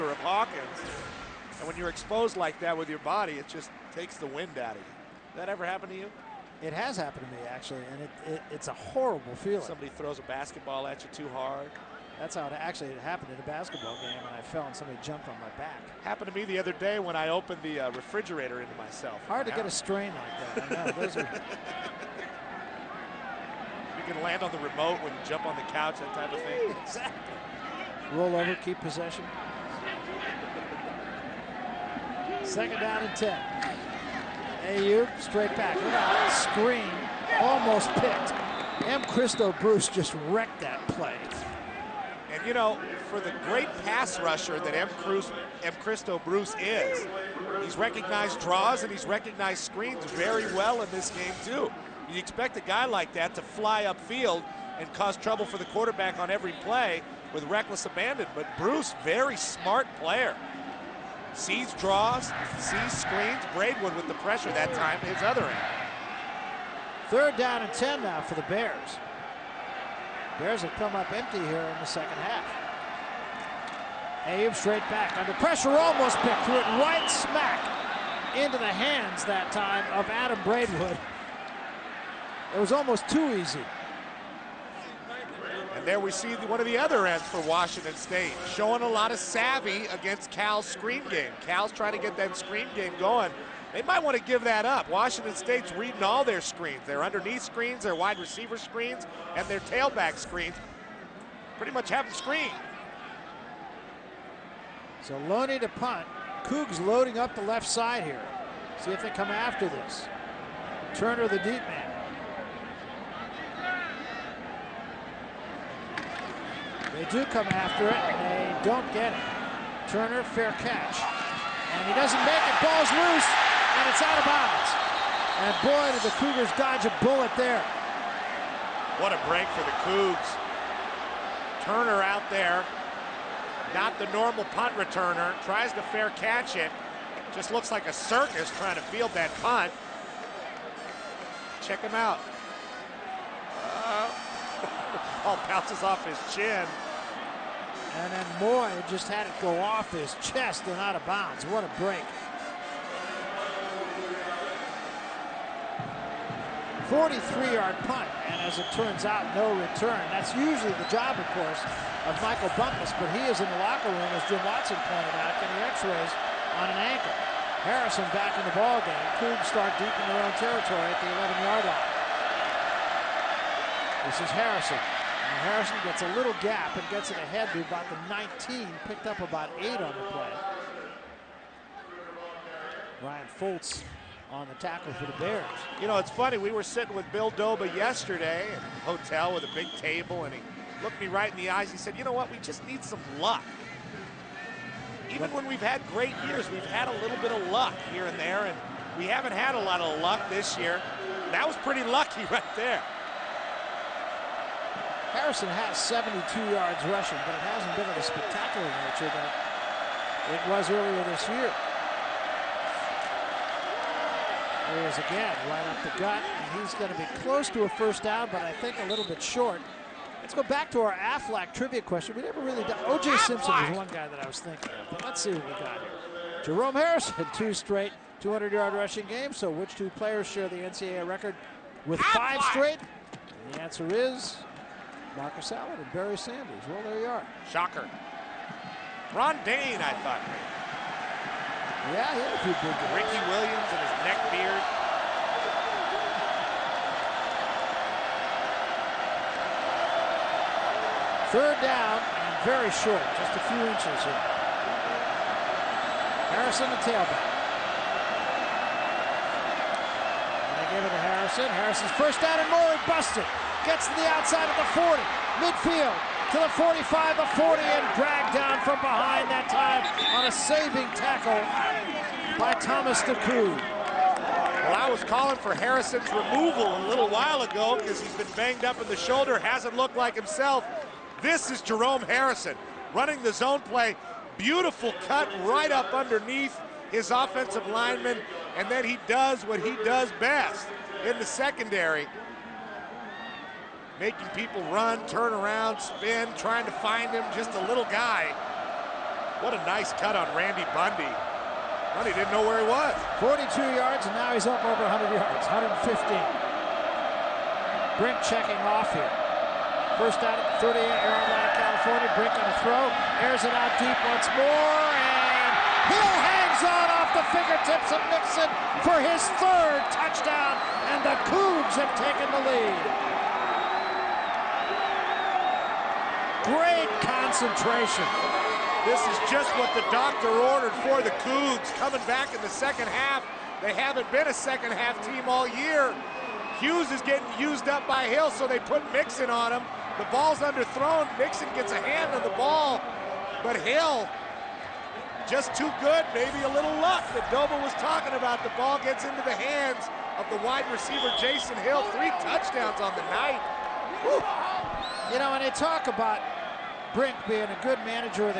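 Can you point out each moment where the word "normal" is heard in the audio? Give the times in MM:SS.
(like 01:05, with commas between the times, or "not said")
02:14.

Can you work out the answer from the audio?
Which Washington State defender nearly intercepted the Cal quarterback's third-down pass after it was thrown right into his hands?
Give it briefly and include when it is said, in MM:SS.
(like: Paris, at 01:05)
Adam Braidwood, at 01:20.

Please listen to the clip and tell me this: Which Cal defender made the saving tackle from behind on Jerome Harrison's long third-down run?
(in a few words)
Thomas DeCoud.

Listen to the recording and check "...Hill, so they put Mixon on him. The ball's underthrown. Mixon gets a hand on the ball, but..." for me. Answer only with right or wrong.
right.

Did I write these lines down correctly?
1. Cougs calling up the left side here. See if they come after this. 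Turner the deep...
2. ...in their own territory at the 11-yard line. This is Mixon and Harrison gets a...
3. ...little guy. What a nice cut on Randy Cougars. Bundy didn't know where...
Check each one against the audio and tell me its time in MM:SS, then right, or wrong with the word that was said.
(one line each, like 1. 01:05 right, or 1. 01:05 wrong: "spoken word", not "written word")
1. 01:46 wrong: "loading", not "calling"
2. 02:50 wrong: "Harrison", not "Mixon"
3. 04:57 wrong: "Bundy", not "Cougars".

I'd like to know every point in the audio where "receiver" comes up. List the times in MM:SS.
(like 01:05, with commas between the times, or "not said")
01:38, 05:50.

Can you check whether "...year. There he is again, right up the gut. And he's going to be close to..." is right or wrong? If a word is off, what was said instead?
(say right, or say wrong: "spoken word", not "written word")
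right.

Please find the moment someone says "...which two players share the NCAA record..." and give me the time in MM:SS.
03:49.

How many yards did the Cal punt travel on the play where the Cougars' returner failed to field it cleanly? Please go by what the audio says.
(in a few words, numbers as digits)
43.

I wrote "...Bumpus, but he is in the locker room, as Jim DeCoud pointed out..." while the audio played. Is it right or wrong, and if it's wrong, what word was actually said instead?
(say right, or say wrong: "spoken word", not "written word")
wrong: "Watson", not "DeCoud".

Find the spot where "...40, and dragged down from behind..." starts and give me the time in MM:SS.
04:27.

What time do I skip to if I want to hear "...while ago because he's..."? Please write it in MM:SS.
04:37.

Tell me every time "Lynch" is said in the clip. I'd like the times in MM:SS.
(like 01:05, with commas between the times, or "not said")
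not said.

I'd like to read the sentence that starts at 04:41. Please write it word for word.
This is Jerome Harrison running the zone play.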